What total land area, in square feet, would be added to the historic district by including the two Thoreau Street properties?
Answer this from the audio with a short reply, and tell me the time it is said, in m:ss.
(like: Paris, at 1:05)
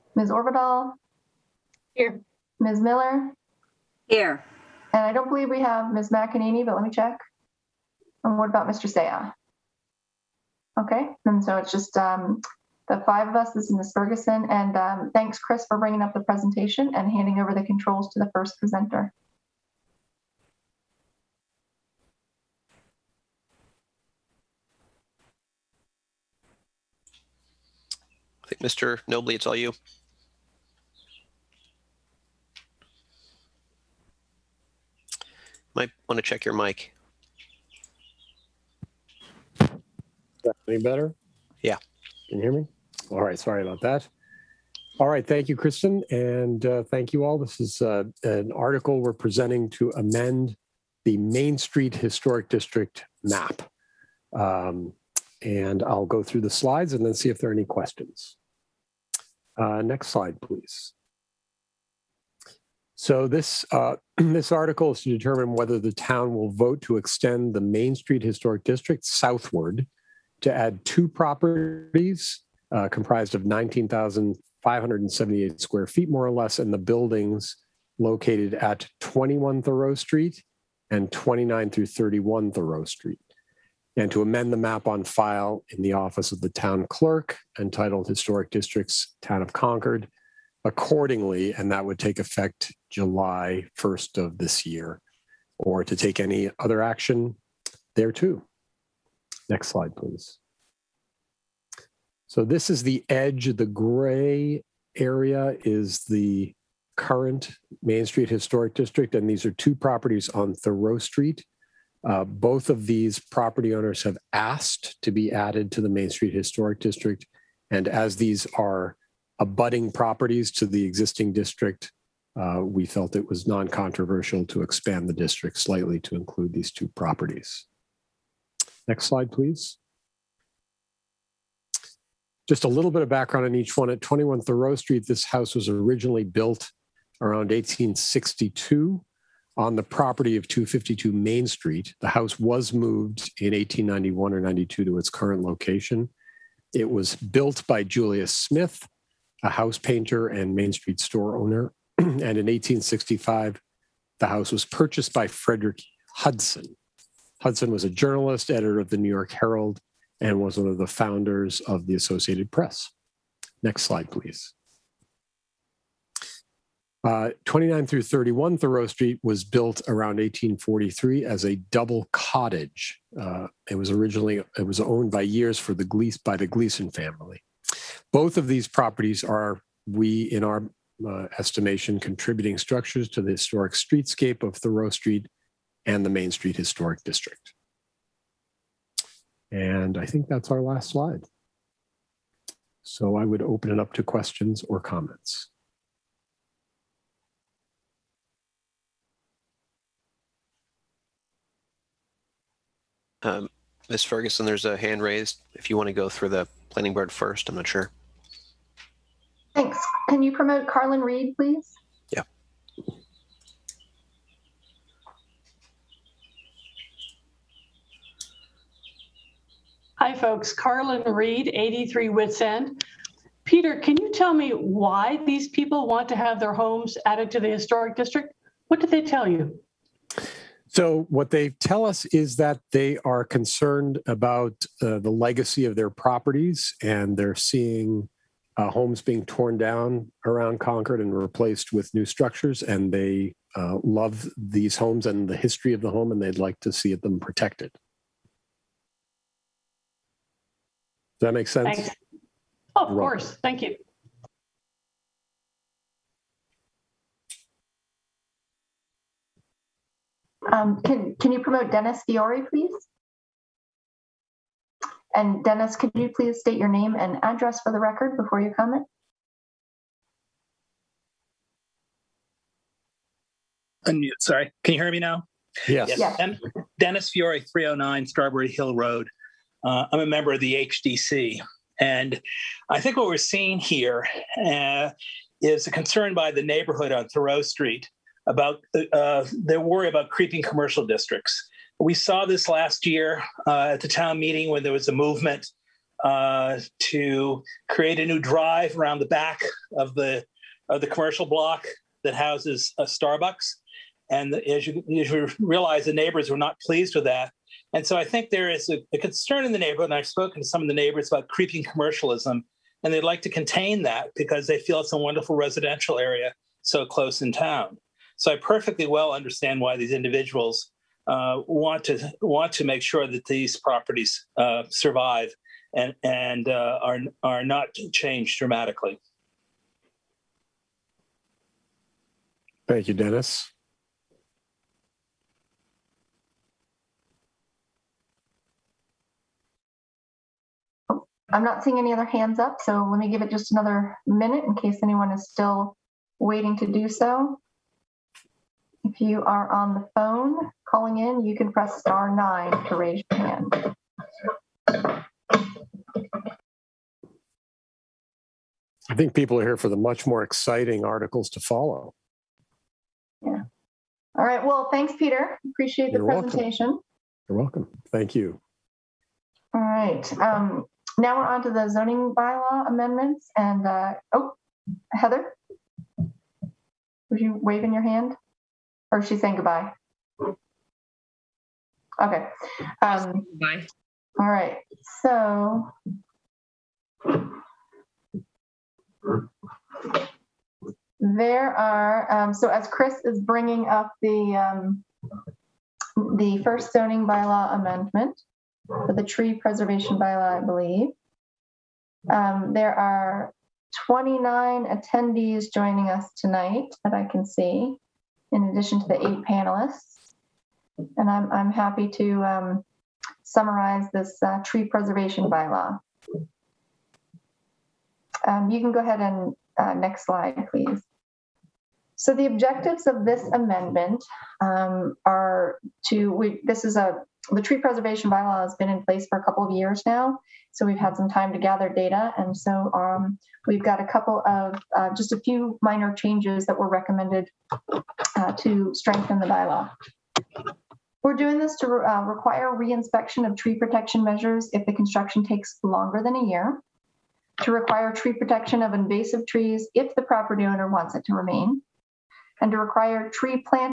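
19,578, at 1:13.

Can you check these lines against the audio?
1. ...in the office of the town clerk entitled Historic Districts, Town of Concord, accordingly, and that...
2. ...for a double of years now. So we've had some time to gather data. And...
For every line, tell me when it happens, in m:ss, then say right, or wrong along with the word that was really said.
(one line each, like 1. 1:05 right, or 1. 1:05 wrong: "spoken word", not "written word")
1. 1:25 right
2. 7:09 wrong: "couple", not "double".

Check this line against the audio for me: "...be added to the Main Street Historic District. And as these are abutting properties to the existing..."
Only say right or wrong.
right.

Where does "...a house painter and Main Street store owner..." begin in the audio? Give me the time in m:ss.
2:29.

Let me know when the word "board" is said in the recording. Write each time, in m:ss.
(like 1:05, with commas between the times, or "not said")
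3:26.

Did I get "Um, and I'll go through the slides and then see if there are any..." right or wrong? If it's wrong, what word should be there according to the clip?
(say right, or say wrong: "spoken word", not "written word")
right.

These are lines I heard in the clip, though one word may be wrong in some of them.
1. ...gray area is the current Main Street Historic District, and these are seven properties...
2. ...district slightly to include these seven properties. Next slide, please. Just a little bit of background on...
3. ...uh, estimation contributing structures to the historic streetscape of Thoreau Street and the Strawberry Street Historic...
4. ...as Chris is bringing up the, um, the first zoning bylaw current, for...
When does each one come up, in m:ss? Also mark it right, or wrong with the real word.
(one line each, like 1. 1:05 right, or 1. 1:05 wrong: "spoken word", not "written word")
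1. 1:43 wrong: "two", not "seven"
2. 2:05 wrong: "two", not "seven"
3. 3:01 wrong: "Main", not "Strawberry"
4. 6:32 wrong: "amendment", not "current".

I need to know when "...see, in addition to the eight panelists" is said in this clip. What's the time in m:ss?
6:47.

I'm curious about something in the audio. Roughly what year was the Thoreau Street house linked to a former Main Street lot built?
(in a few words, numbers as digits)
1862.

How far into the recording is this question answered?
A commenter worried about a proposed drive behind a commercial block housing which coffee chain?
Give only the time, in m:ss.
5:02.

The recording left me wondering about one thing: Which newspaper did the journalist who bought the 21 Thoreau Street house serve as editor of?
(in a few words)
New York Herald.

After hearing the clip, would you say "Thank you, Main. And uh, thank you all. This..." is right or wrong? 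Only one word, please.
wrong.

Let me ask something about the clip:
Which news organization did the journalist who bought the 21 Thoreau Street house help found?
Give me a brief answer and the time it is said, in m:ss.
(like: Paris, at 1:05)
Associated Press, at 2:41.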